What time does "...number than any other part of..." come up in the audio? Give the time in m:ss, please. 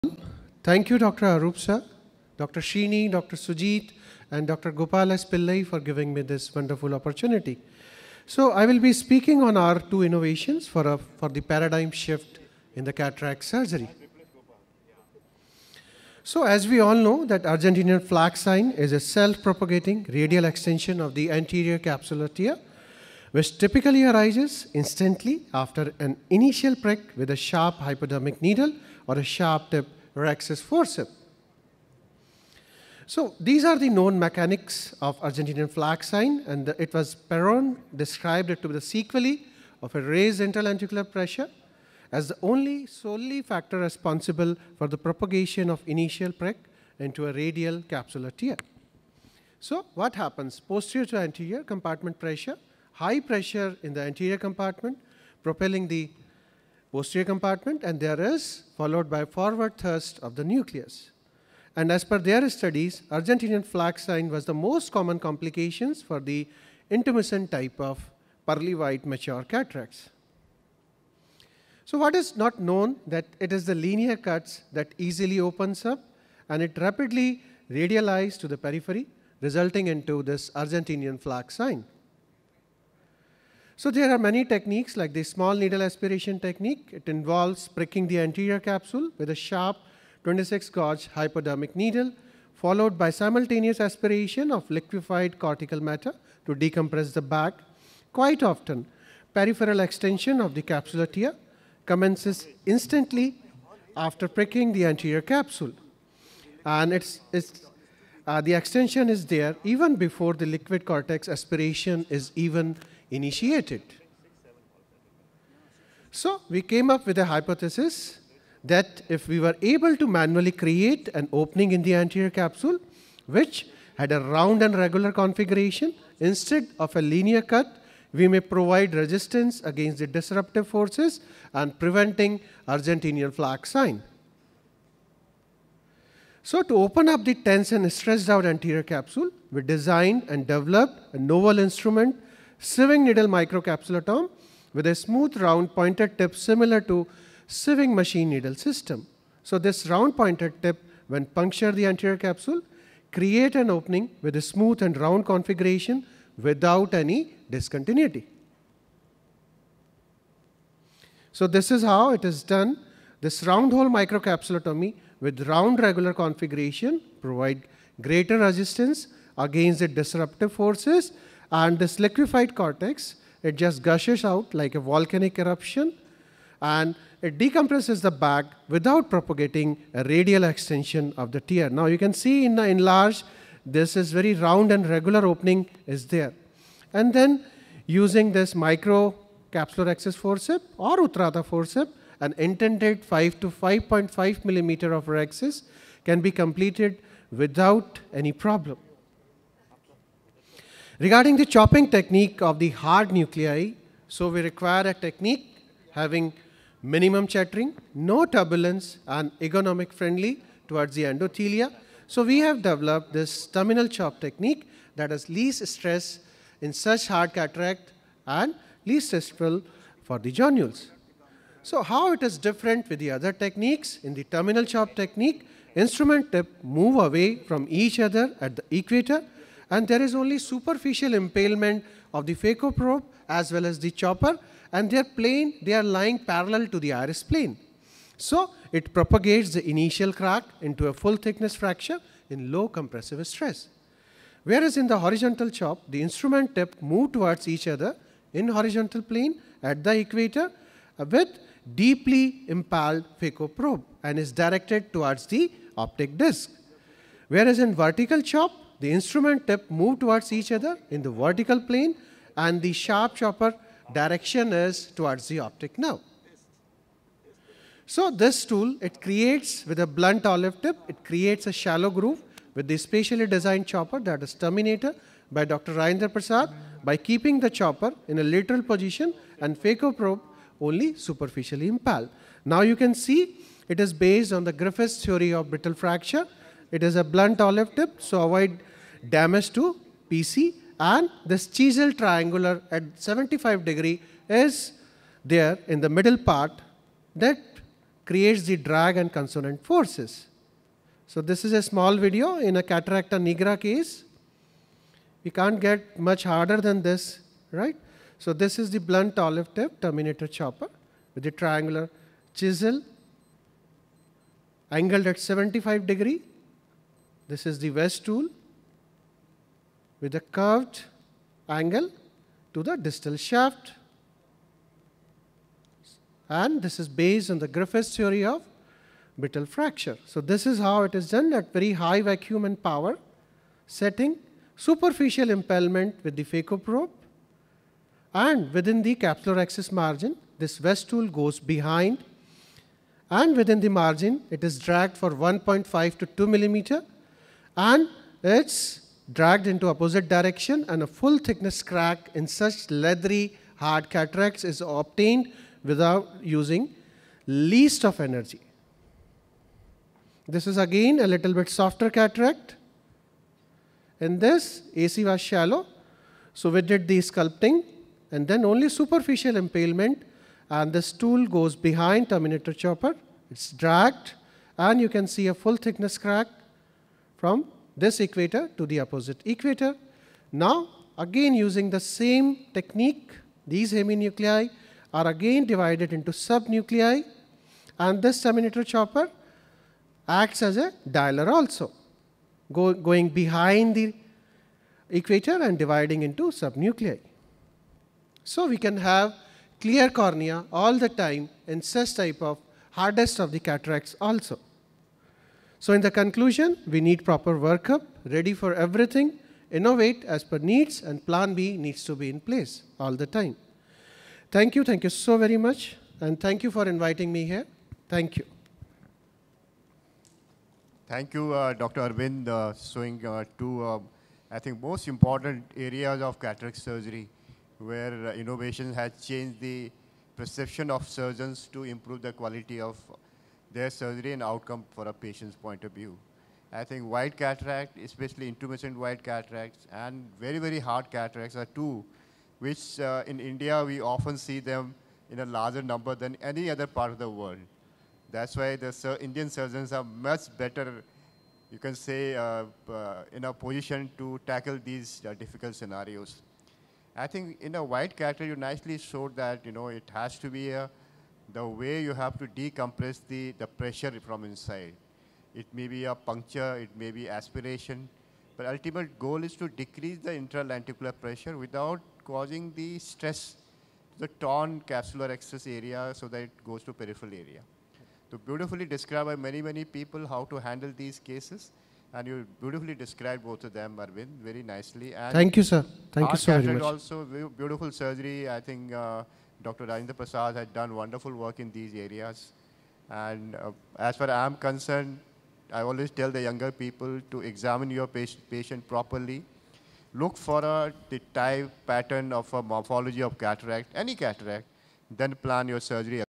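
7:25.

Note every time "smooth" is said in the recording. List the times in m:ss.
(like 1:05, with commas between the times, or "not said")
2:24, 2:34.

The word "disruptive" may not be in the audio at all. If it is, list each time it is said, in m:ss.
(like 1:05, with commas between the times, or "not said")
2:10, 2:49.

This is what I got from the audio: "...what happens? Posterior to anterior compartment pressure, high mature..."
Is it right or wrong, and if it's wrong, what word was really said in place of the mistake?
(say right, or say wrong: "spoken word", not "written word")
wrong: "pressure", not "mature".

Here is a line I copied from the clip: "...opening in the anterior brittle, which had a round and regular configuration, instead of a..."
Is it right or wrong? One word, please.
wrong.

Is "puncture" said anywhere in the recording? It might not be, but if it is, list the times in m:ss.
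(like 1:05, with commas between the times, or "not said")
2:31, 7:45.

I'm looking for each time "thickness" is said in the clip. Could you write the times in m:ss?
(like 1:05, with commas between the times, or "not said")
4:01, 5:51, 6:15.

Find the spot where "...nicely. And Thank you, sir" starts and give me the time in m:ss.
8:04.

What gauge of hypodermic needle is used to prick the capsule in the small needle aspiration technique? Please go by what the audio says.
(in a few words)
26.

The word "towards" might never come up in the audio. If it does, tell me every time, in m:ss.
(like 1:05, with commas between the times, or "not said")
3:30, 4:07, 4:14, 4:19, 4:24.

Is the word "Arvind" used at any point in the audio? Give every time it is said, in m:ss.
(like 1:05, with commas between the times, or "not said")
7:01, 8:03.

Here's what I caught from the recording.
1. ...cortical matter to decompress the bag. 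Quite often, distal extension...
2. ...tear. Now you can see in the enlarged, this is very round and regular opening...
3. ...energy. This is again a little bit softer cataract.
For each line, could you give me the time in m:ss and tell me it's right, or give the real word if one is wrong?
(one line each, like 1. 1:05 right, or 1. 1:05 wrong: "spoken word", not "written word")
1. 1:35 wrong: "peripheral", not "distal"
2. 3:01 right
3. 5:57 right.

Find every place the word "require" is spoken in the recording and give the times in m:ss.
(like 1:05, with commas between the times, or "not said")
3:24.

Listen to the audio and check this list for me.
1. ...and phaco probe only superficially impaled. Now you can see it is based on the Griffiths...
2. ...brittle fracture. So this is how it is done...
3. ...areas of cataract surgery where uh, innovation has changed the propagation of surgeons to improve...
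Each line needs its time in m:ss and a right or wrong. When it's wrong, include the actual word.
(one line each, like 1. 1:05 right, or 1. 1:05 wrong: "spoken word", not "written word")
1. 4:39 right
2. 5:29 right
3. 7:05 wrong: "perception", not "propagation".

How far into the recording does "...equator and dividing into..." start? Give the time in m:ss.
6:34.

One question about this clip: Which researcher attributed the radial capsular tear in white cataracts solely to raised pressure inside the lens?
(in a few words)
Perron.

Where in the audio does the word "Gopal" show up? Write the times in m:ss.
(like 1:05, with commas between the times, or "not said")
0:04.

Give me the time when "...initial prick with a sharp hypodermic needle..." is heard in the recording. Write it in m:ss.
0:26.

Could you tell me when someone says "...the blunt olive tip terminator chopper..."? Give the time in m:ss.
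5:08.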